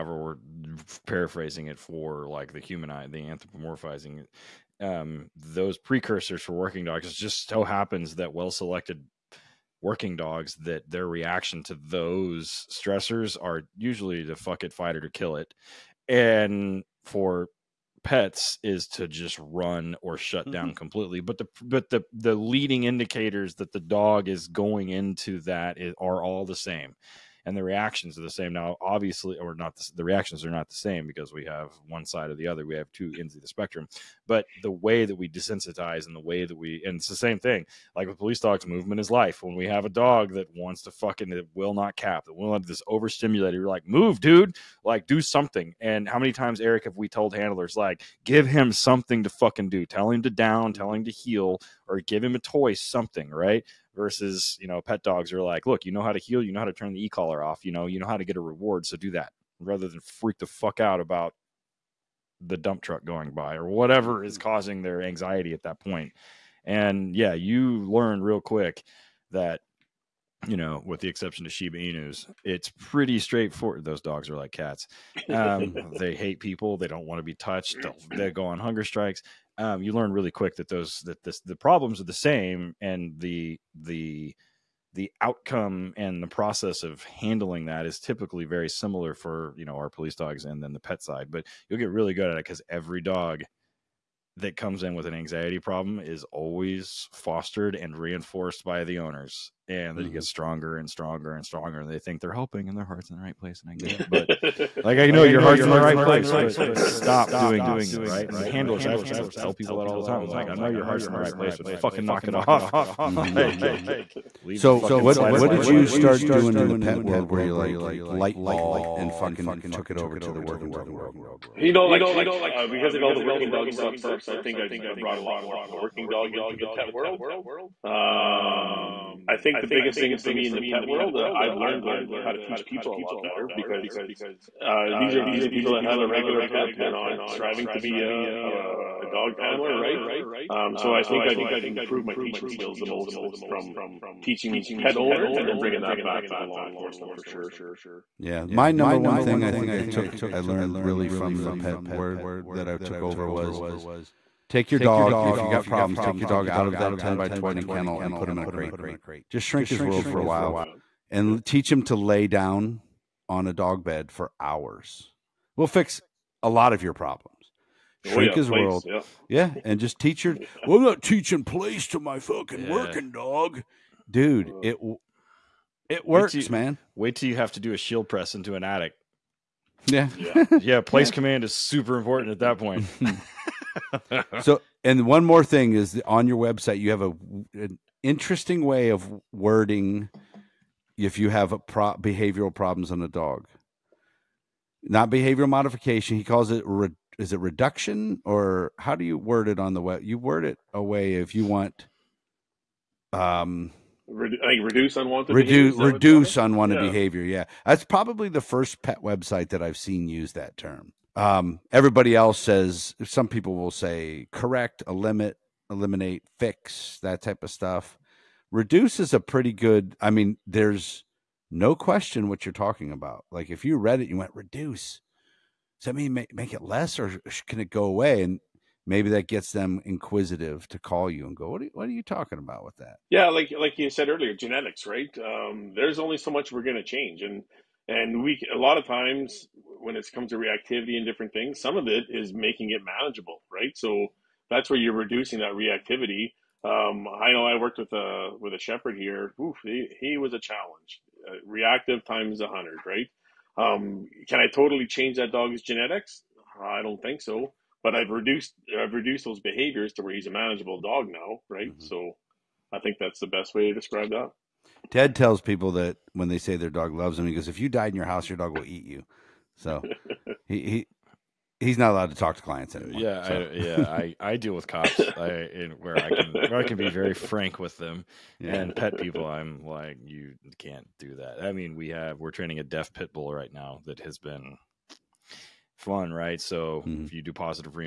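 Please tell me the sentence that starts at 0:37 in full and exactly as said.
Like with police dogs, movement is life.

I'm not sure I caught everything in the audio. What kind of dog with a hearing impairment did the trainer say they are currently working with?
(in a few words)
a deaf pit bull.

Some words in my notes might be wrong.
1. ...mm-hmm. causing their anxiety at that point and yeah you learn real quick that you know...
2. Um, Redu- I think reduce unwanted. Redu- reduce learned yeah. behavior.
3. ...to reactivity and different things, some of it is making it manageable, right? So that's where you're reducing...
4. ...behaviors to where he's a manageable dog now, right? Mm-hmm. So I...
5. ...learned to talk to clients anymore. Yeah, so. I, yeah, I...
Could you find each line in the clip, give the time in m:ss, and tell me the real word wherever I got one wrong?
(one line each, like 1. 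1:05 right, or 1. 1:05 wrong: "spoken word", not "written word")
1. 1:04 right
2. 3:23 wrong: "unwanted", not "learned"
3. 4:00 right
4. 4:19 right
5. 4:31 wrong: "allowed", not "learned".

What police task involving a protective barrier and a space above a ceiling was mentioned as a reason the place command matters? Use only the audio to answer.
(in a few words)
a shield press.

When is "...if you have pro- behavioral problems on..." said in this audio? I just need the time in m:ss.
3:10.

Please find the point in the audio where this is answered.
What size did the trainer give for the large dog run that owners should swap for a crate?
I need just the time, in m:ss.
2:36.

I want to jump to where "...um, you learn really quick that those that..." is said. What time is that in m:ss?
1:19.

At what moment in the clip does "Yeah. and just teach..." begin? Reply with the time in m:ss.
2:49.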